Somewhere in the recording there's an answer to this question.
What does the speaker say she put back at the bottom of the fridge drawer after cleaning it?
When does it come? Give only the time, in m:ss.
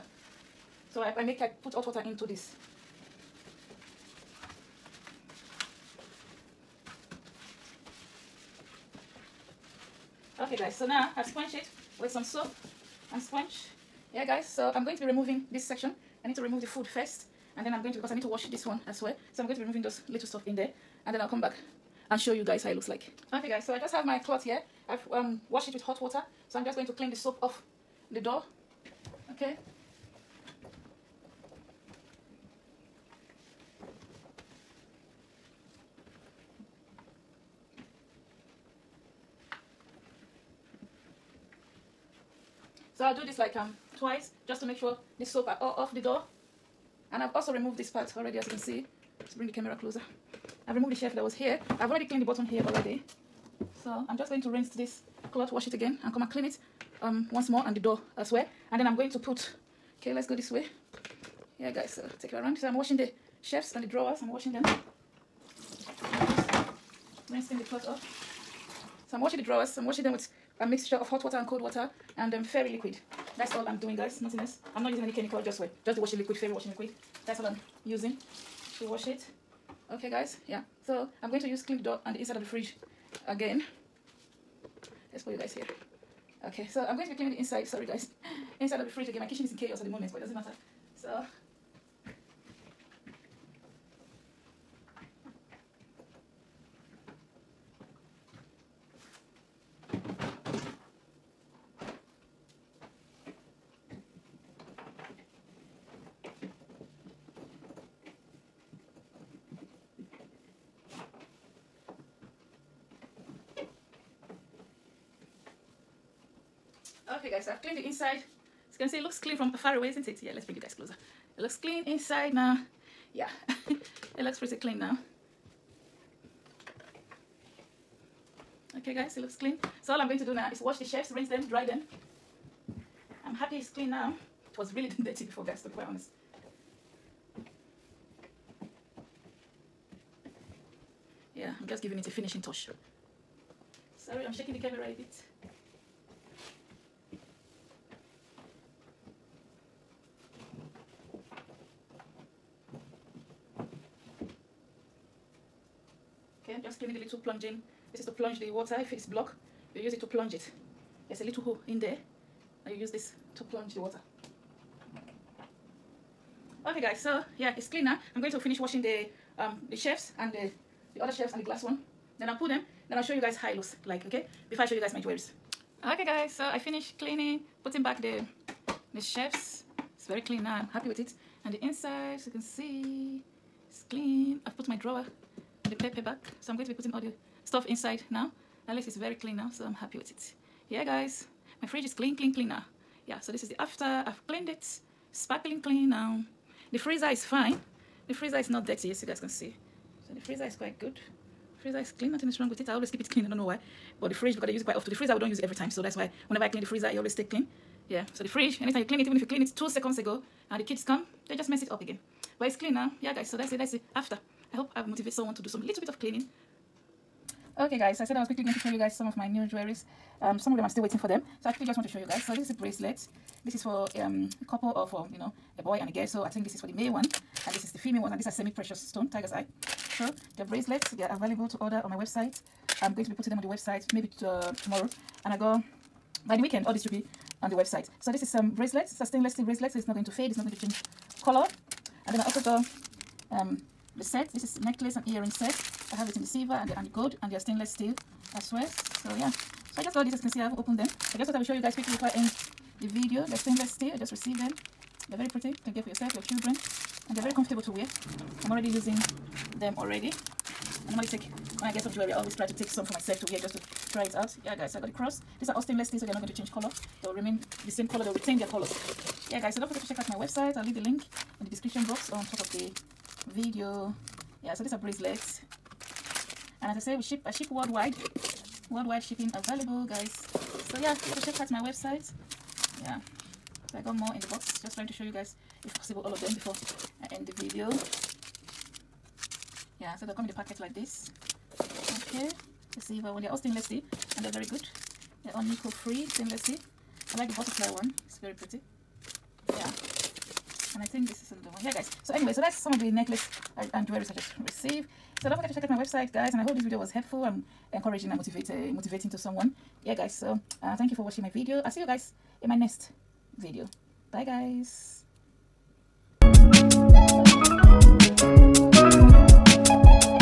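3:05.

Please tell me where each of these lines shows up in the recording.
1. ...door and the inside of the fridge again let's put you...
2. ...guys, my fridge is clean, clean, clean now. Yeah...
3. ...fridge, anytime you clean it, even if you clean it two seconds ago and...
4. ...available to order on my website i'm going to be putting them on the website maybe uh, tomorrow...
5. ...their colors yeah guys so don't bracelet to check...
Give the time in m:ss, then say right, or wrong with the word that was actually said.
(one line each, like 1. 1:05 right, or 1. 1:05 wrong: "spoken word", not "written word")
1. 1:21 right
2. 3:10 right
3. 3:28 right
4. 3:51 right
5. 4:28 wrong: "forget", not "bracelet".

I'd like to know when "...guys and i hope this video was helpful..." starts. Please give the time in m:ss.
5:06.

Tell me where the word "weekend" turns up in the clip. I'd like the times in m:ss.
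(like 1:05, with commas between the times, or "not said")
3:56.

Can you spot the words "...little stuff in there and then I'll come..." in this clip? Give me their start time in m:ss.
0:20.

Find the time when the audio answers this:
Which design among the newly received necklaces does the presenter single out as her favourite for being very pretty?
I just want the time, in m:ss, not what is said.
4:57.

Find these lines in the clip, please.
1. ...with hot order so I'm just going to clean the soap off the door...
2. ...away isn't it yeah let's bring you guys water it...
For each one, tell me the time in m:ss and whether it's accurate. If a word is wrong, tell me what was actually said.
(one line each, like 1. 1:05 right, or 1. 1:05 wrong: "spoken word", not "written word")
1. 0:25 wrong: "water", not "order"
2. 1:59 wrong: "closer", not "water".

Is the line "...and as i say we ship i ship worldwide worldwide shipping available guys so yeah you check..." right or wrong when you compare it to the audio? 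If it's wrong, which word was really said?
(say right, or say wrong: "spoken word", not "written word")
right.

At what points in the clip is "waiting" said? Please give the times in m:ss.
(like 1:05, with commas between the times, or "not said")
3:40.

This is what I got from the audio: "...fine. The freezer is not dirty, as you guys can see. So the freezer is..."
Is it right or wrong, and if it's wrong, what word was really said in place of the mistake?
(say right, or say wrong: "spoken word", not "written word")
right.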